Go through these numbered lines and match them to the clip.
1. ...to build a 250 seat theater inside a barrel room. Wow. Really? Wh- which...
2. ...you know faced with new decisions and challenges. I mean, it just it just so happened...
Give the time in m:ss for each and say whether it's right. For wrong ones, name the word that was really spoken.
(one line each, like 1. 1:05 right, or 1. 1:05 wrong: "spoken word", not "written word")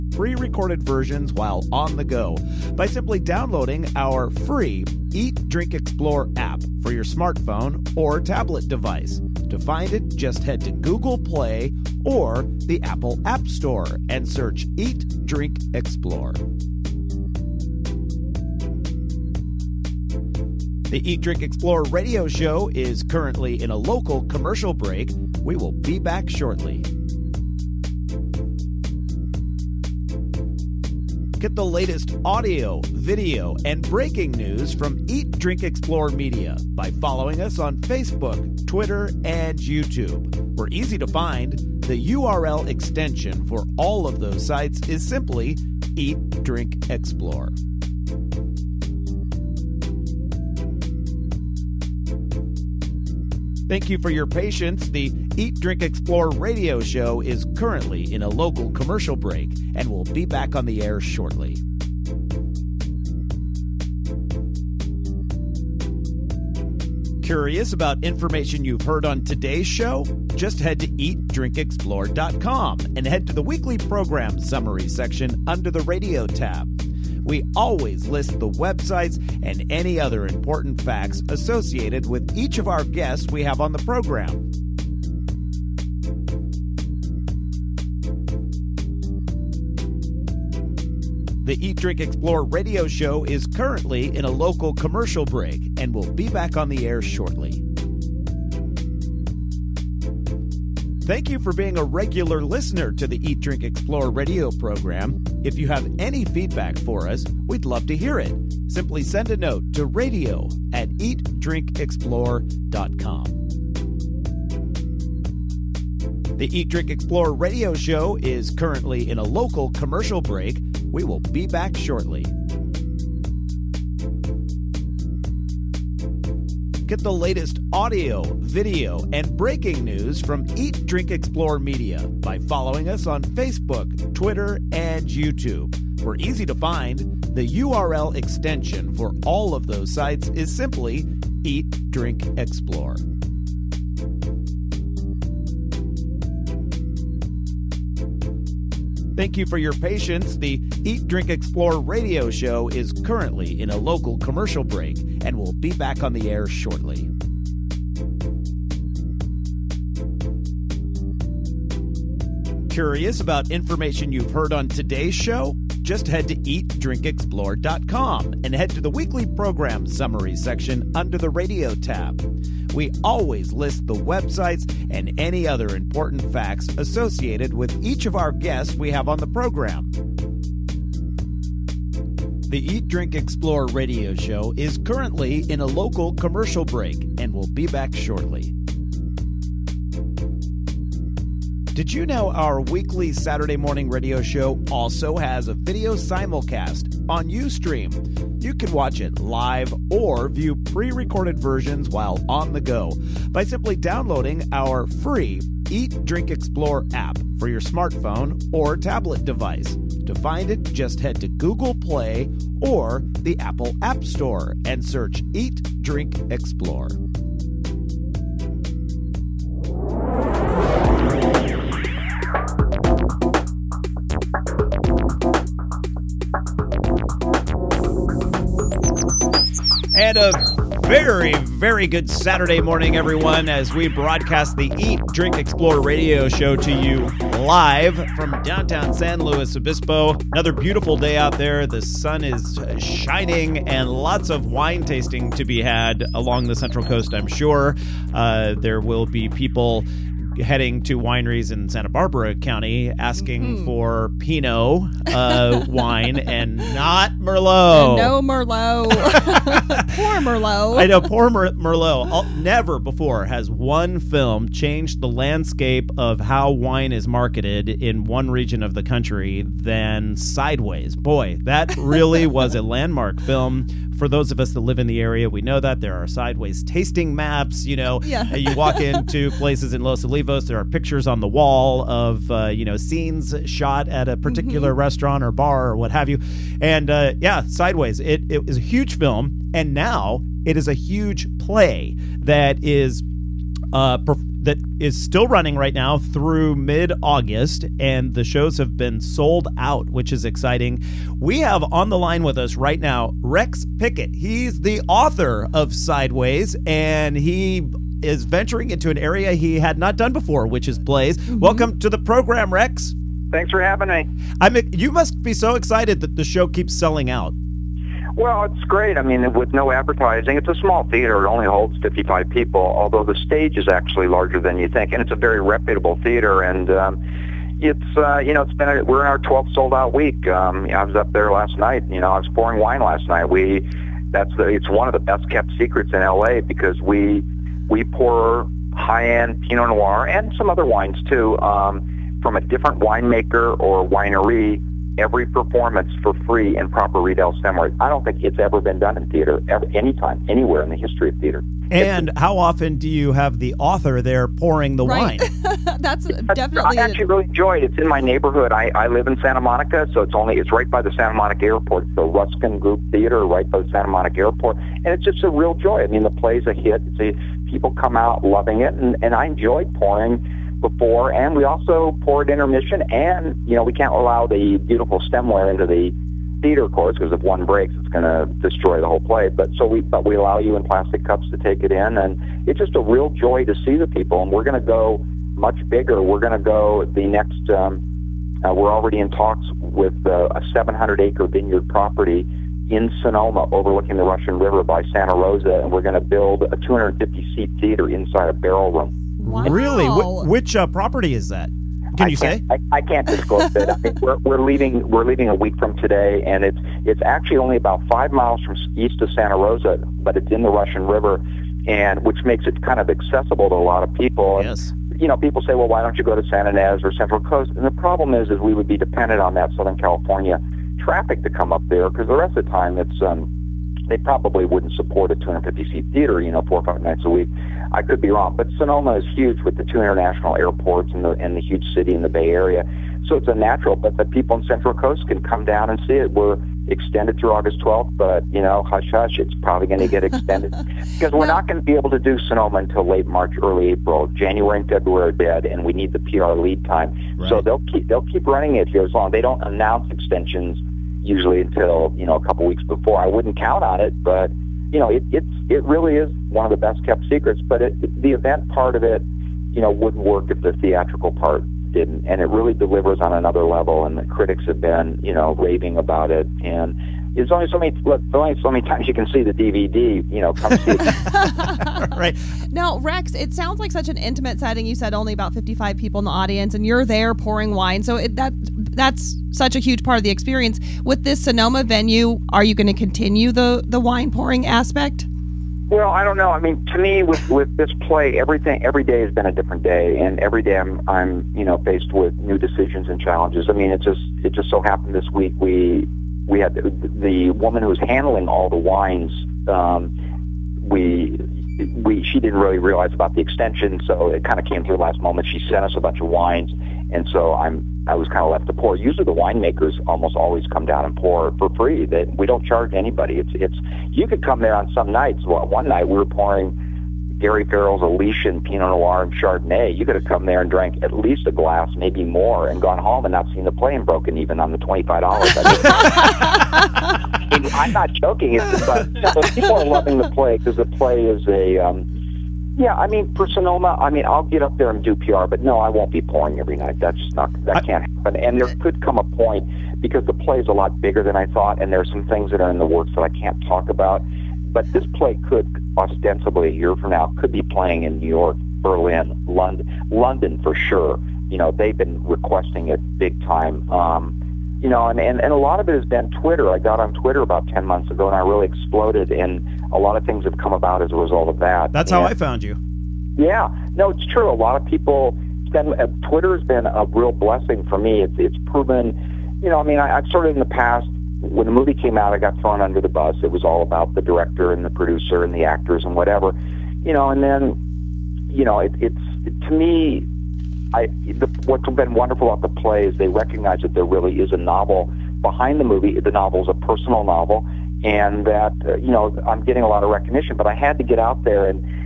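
1. 6:35 right
2. 8:11 right.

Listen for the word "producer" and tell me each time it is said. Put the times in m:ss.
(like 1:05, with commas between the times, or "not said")
9:34.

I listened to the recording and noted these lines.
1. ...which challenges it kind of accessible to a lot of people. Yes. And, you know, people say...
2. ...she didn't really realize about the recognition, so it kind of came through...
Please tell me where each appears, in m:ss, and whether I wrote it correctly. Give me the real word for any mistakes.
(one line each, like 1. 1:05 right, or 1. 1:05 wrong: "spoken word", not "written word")
1. 6:52 wrong: "makes", not "challenges"
2. 8:22 wrong: "extension", not "recognition".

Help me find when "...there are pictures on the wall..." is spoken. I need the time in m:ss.
4:40.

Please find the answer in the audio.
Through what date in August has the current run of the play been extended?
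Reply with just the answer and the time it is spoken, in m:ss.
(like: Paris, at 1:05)
August 12, at 7:17.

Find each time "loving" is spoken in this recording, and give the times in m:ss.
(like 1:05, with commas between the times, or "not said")
6:08, 8:49.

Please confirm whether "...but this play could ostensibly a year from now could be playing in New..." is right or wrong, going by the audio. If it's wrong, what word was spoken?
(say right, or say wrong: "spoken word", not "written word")
right.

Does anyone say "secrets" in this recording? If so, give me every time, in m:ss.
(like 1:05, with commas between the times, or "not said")
5:35, 7:37.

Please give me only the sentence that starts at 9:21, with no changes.
That's and, how I found you.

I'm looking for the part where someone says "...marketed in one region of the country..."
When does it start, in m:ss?
4:27.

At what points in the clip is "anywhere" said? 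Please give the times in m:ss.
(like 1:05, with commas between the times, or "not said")
5:50.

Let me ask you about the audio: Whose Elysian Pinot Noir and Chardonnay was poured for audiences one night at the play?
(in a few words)
Gary Farrell.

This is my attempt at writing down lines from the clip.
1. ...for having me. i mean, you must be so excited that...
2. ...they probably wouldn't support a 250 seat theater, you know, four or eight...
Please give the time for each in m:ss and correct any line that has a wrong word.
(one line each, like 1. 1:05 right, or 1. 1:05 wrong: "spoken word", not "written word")
1. 5:13 right
2. 7:03 wrong: "five", not "eight".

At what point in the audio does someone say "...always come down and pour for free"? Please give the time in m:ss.
8:30.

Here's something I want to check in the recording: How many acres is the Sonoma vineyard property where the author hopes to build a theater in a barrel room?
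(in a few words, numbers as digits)
700.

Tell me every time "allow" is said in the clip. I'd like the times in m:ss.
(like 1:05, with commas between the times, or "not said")
6:13, 6:20.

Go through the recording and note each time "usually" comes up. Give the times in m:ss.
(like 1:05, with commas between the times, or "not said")
7:31, 8:28.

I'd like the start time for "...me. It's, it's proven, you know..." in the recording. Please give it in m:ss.
9:27.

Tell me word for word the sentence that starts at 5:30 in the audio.
Um, I was up there last night.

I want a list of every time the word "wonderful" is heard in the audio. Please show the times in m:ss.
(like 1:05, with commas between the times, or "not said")
9:41.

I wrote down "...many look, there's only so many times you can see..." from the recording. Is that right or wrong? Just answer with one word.
right.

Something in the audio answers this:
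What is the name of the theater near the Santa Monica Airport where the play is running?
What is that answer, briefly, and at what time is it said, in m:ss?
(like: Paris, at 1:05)
Ruskin Group Theater, at 6:02.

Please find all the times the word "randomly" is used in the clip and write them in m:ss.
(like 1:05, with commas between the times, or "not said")
not said.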